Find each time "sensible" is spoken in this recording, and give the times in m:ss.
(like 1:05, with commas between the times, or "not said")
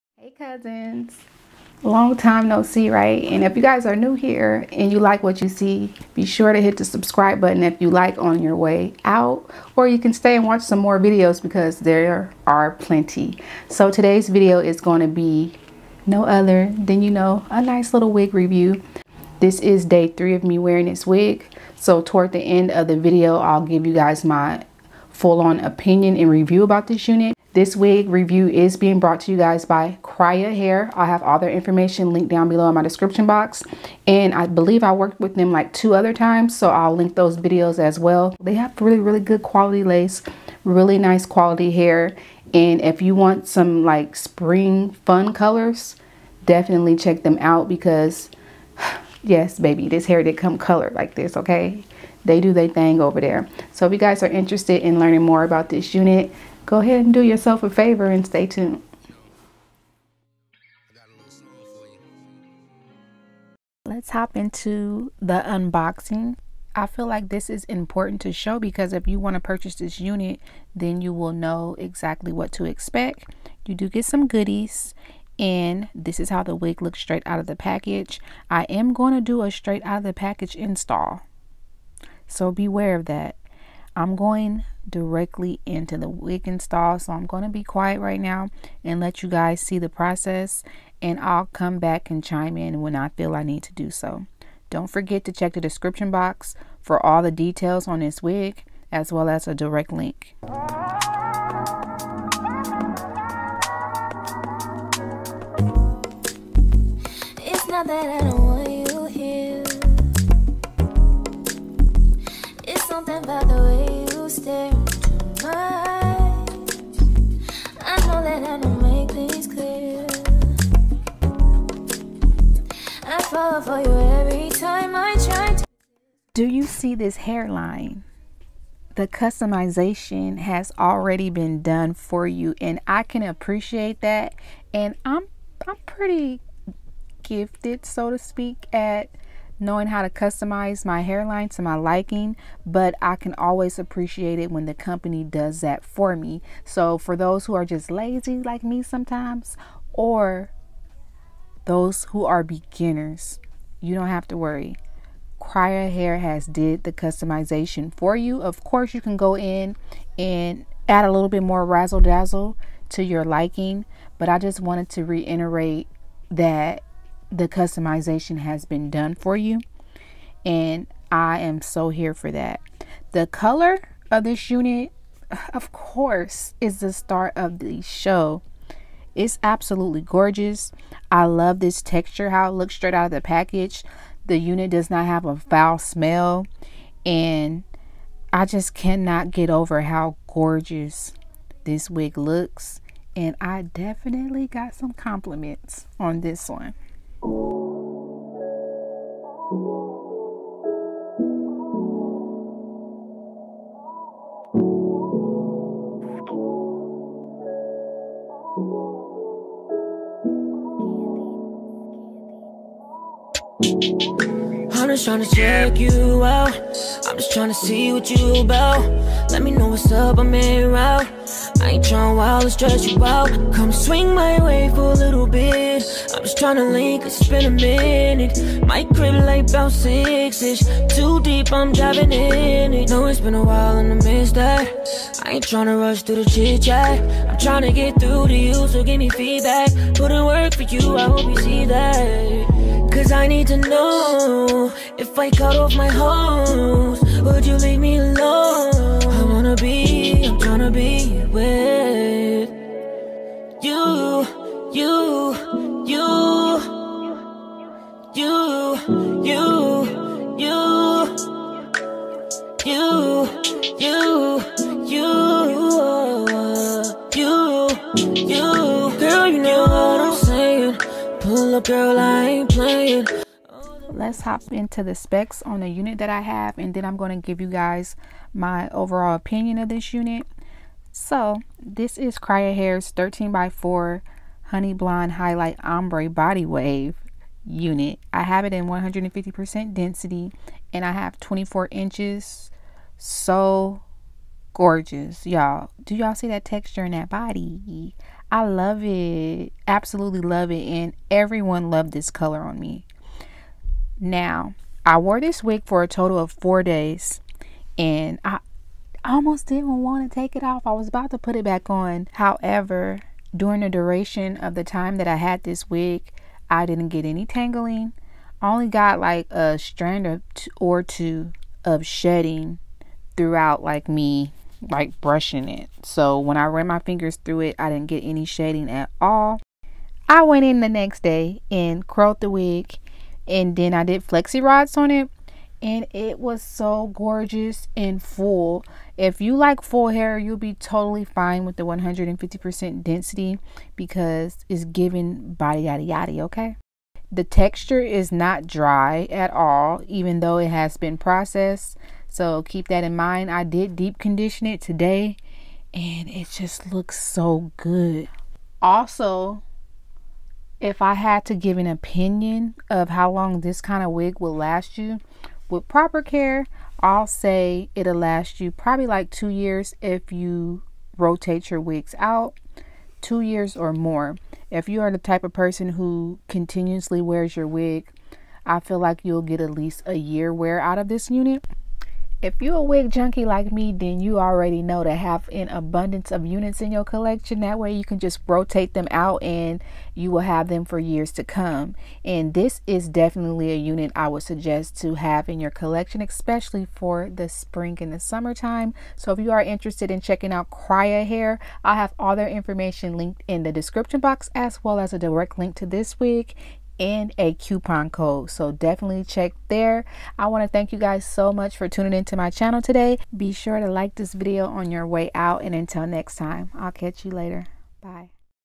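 not said.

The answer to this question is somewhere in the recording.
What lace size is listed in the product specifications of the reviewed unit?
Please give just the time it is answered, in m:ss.
4:42.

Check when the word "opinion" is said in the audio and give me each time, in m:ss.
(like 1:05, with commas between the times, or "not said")
0:25, 4:39, 6:01.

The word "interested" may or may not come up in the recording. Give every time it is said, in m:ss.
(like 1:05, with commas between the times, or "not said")
0:54, 6:39.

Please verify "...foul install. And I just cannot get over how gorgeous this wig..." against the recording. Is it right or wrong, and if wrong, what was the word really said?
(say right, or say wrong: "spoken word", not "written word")
wrong: "smell", not "install".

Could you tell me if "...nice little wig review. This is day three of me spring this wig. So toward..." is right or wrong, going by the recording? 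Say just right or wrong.
wrong.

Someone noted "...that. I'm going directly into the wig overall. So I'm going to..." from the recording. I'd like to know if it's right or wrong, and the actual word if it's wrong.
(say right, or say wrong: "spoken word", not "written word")
wrong: "install", not "overall".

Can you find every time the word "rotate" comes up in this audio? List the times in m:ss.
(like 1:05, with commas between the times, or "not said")
6:10, 6:28.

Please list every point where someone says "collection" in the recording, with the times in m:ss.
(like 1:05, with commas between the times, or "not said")
6:26, 6:35.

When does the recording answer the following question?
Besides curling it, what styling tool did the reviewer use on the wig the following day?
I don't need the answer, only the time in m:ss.
5:34.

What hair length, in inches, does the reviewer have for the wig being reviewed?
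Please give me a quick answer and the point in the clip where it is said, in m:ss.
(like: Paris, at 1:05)
24 inches, at 4:51.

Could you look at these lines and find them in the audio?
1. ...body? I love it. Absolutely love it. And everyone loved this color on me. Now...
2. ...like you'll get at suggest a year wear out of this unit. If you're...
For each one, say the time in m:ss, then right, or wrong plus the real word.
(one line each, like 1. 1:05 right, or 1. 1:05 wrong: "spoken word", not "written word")
1. 4:57 right
2. 6:18 wrong: "least", not "suggest".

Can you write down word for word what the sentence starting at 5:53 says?
I did deep condition it today and it just looks so good.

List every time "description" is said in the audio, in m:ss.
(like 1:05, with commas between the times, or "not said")
0:32, 1:35, 6:43.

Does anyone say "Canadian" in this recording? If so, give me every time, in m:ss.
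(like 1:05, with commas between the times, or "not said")
not said.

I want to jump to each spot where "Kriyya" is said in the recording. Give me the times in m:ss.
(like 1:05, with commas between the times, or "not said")
0:30, 2:35, 4:42, 6:40.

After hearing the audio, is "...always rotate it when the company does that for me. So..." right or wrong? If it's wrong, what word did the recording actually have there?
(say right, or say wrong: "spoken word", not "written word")
wrong: "appreciate", not "rotate".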